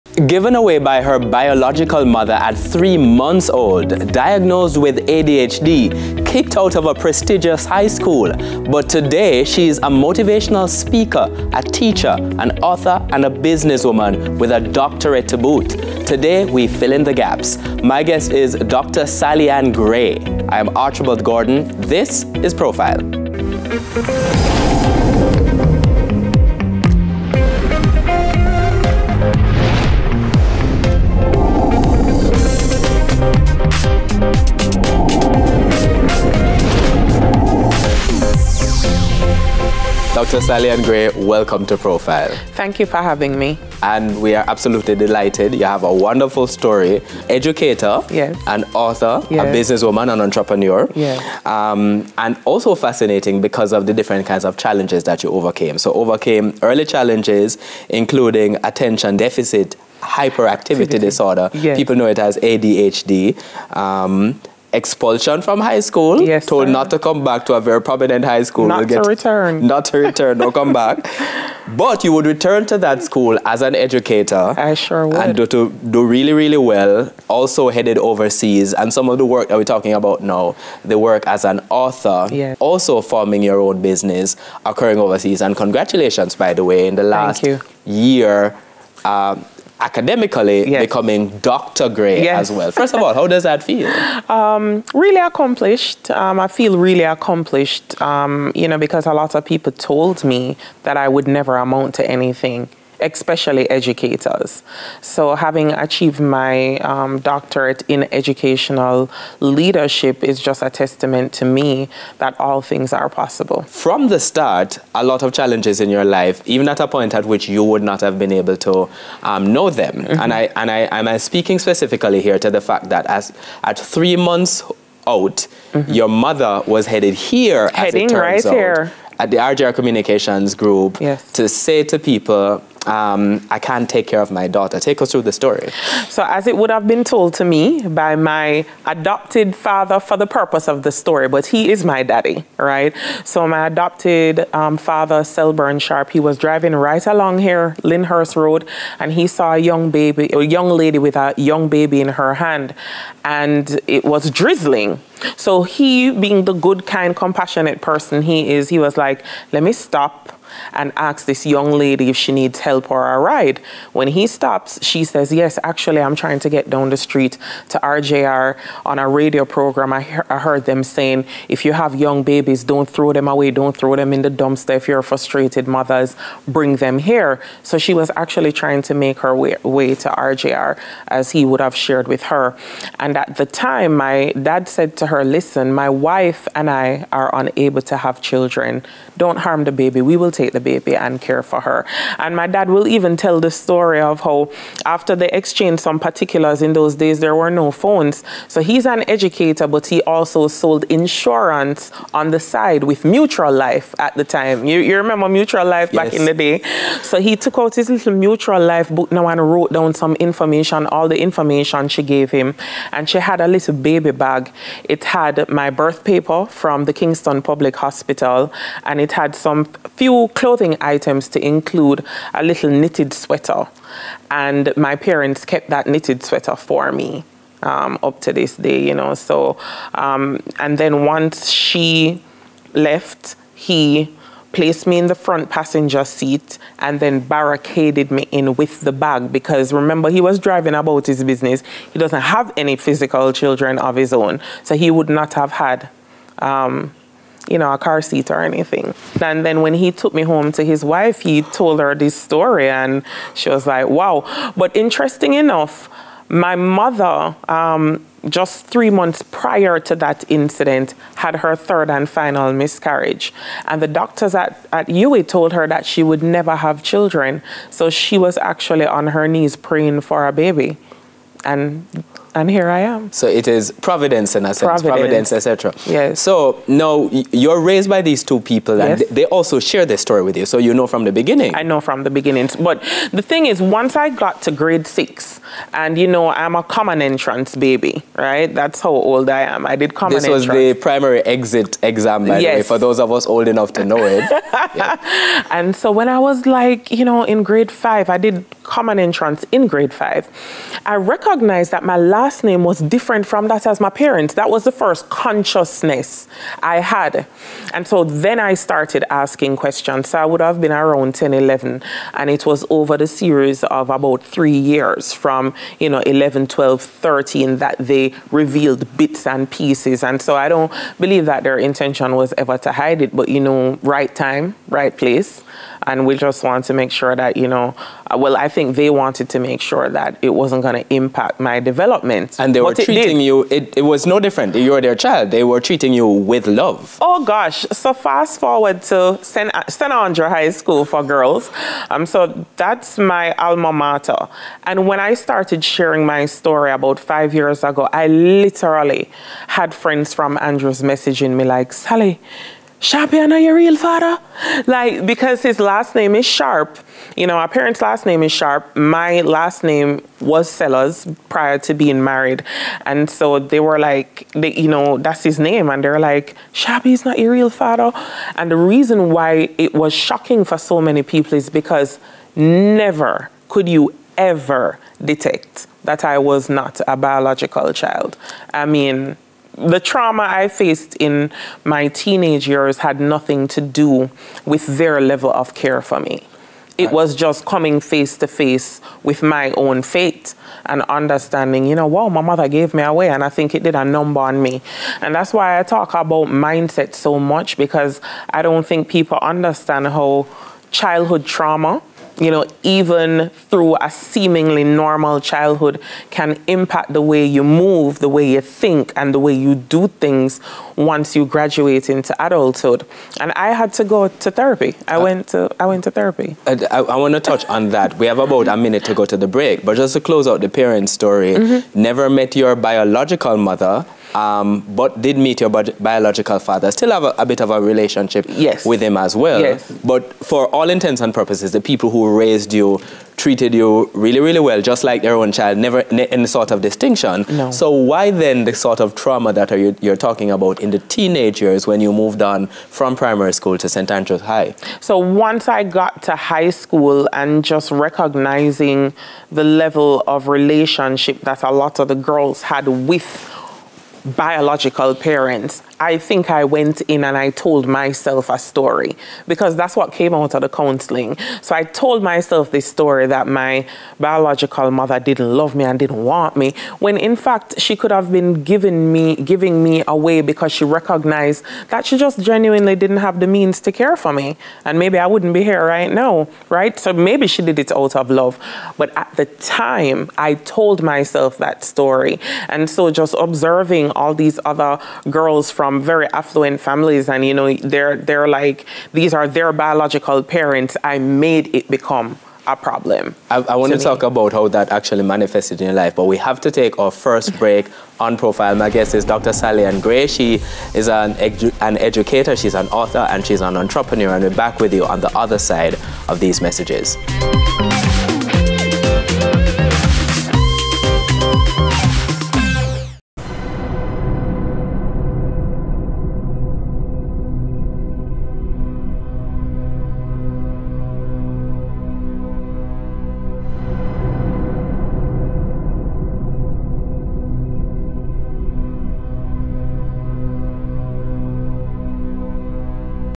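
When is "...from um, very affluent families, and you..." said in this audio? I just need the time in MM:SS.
08:05.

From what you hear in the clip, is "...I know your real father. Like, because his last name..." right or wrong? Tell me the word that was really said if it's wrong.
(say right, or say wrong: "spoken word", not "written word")
right.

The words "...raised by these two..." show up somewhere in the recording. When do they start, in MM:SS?
04:37.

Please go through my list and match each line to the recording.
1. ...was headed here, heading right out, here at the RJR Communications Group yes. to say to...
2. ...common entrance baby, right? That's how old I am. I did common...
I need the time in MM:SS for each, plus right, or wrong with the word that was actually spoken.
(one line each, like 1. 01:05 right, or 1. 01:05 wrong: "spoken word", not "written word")
1. 02:06 right
2. 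04:46 right.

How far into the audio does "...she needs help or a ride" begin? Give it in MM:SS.
02:42.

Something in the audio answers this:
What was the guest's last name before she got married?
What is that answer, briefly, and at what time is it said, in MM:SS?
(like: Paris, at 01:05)
Sellers, at 06:00.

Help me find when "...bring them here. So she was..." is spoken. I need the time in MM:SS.
02:56.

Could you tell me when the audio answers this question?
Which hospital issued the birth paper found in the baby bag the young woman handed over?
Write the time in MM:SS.
03:36.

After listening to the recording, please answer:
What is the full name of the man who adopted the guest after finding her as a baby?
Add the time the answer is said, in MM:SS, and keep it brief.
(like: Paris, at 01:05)
Selburn Sharp, at 02:25.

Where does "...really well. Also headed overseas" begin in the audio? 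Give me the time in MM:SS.
01:16.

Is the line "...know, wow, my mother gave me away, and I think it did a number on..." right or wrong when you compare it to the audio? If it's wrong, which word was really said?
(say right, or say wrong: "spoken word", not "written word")
right.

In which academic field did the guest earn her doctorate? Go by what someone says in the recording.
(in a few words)
Educational leadership.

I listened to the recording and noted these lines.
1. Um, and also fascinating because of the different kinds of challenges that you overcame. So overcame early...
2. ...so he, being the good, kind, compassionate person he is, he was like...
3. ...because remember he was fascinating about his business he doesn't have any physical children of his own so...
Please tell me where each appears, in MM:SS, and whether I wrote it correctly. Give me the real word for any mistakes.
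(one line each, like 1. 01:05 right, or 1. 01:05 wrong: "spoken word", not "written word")
1. 00:51 right
2. 02:35 right
3. 03:59 wrong: "driving", not "fascinating".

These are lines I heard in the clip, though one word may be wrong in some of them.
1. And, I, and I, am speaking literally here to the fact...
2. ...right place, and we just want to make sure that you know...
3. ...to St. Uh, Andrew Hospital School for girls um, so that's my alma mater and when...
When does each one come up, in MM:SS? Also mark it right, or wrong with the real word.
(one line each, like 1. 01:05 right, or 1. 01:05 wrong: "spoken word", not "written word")
1. 02:00 wrong: "specifically", not "literally"
2. 05:24 right
3. 05:38 wrong: "High", not "Hospital".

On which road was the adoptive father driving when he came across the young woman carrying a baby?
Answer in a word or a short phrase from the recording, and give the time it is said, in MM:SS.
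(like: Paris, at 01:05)
Lyndhurst Road, at 02:27.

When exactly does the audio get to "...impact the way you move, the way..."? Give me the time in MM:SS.
06:46.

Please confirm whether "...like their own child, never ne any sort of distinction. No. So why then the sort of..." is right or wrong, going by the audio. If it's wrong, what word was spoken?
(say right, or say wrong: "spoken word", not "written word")
right.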